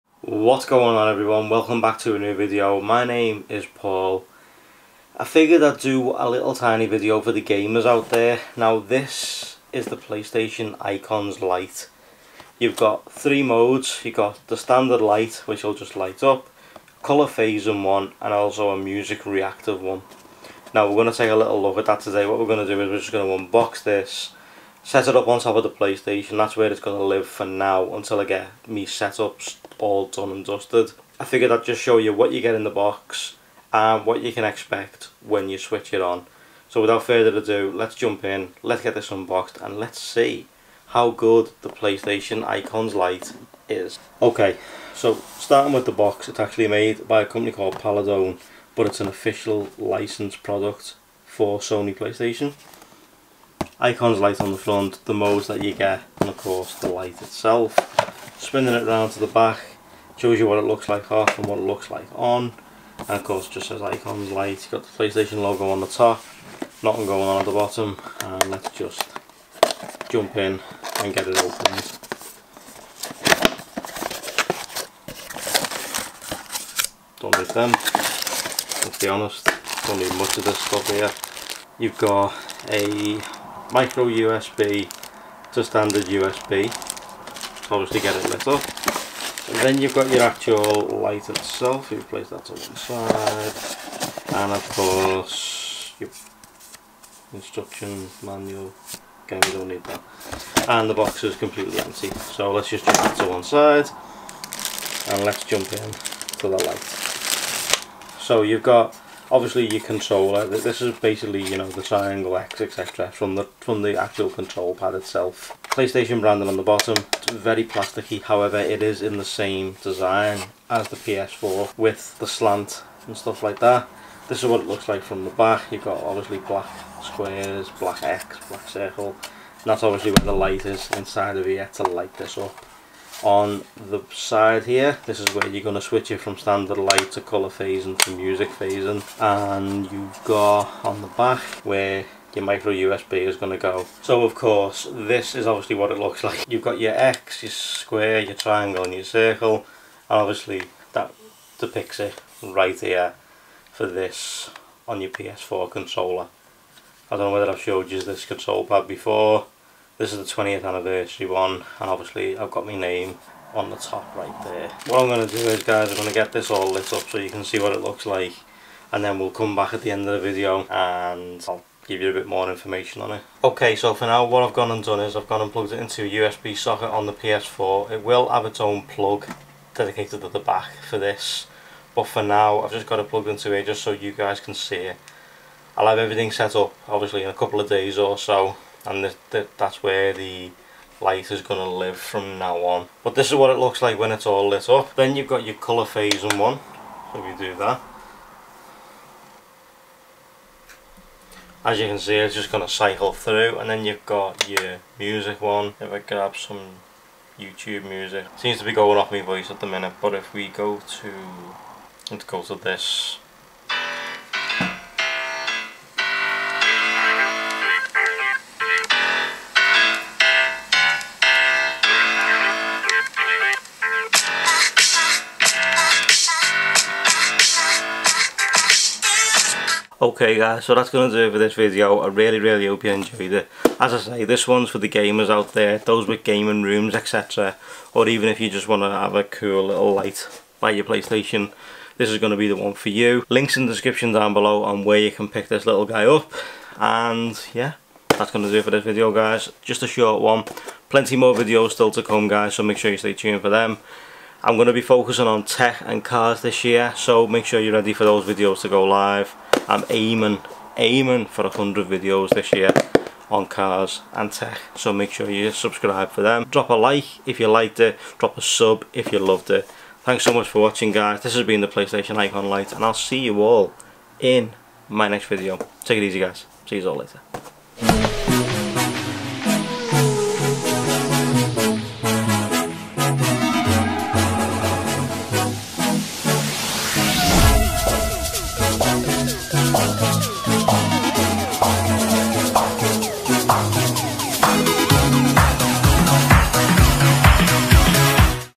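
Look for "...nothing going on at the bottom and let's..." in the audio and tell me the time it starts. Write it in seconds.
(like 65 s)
66 s.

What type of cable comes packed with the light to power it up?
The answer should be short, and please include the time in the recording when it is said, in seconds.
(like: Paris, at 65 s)
Micro USB to standard USB, at 83 s.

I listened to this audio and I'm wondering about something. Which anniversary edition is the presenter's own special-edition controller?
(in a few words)
20th anniversary.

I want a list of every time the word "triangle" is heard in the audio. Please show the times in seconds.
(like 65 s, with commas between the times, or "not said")
111 s, 148 s.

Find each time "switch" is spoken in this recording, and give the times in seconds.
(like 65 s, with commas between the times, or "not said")
35 s, 135 s.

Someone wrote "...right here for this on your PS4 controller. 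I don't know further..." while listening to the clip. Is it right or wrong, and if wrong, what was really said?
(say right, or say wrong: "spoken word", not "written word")
wrong: "whether", not "further".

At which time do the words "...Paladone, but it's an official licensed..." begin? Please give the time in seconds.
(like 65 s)
47 s.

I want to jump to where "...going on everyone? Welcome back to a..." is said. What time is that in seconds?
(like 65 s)
0 s.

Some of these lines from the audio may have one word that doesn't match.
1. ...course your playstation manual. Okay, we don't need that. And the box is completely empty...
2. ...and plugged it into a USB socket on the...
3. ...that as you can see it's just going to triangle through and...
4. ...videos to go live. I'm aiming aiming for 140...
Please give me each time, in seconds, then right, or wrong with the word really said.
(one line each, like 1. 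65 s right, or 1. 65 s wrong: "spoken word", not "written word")
1. 94 s wrong: "instruction", not "playstation"
2. 175 s right
3. 197 s wrong: "cycle", not "triangle"
4. 258 s wrong: "100", not "140".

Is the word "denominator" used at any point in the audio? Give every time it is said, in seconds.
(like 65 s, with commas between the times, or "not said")
not said.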